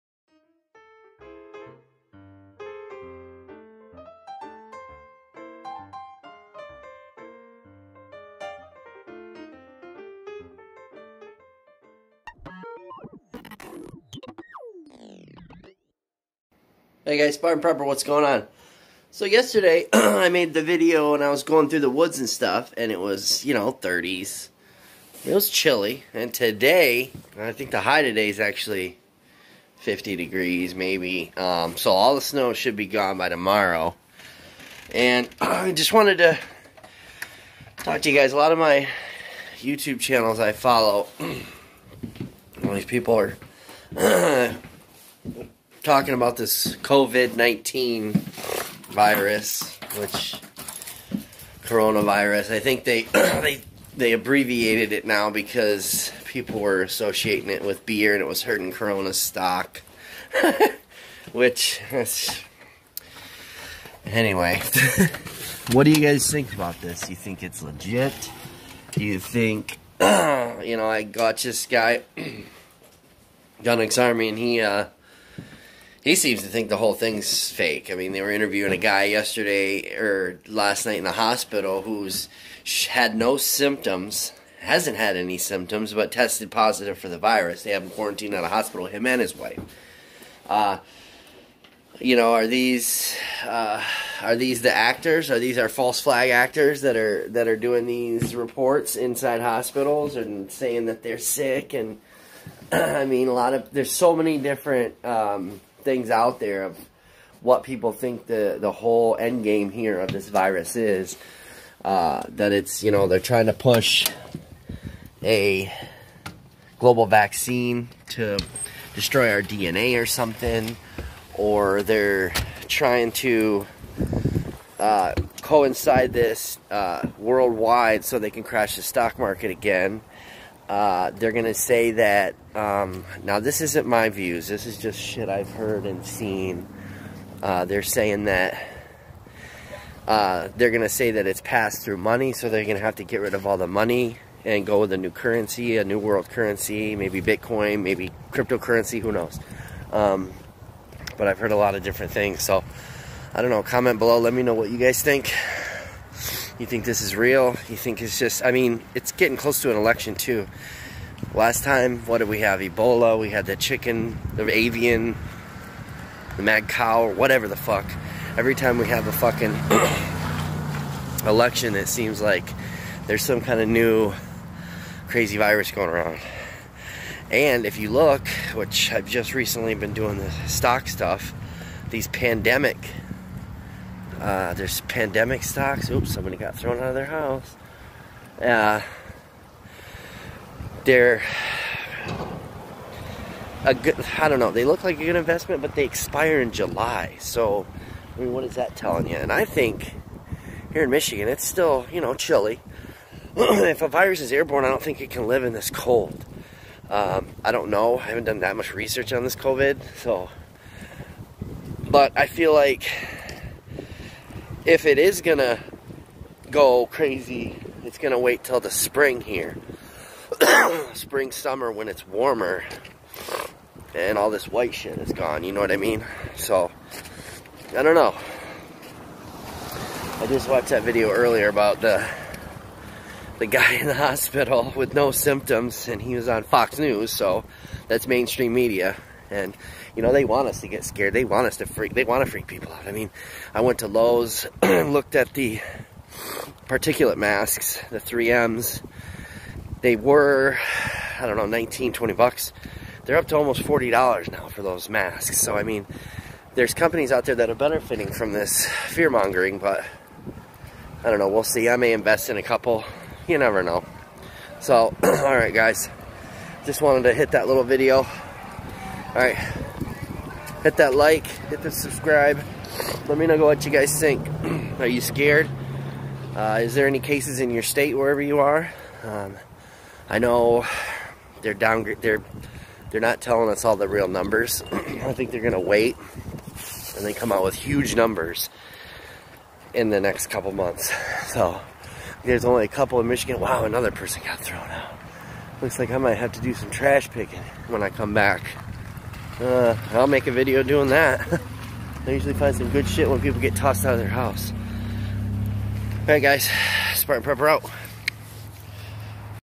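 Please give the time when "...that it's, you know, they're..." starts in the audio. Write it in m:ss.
1:52.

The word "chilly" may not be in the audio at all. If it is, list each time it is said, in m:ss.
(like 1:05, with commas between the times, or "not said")
0:25, 3:22.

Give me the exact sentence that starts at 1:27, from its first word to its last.
They have him quarantined at a hospital, him and his wife.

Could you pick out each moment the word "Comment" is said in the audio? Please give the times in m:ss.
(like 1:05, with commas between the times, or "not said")
2:33.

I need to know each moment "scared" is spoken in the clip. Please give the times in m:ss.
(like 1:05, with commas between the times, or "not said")
4:00, 4:35.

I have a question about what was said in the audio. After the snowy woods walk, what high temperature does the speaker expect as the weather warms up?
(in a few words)
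50 degrees.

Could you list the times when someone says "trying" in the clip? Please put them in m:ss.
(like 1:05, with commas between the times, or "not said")
1:53, 2:02.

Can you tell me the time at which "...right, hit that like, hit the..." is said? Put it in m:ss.
4:29.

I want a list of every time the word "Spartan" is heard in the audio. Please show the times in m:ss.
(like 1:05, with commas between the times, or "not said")
0:17, 5:06.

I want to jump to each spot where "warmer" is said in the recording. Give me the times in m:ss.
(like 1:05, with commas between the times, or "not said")
3:42.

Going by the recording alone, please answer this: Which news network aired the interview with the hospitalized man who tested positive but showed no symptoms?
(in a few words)
Fox News.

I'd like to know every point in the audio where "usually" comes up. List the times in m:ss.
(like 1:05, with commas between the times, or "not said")
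5:02.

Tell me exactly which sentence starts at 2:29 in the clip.
Um, but I've heard a lot of different things, so I don't know.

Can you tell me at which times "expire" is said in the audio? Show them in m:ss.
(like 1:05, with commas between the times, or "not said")
3:15.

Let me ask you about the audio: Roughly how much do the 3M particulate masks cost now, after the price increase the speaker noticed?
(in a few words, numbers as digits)
$40.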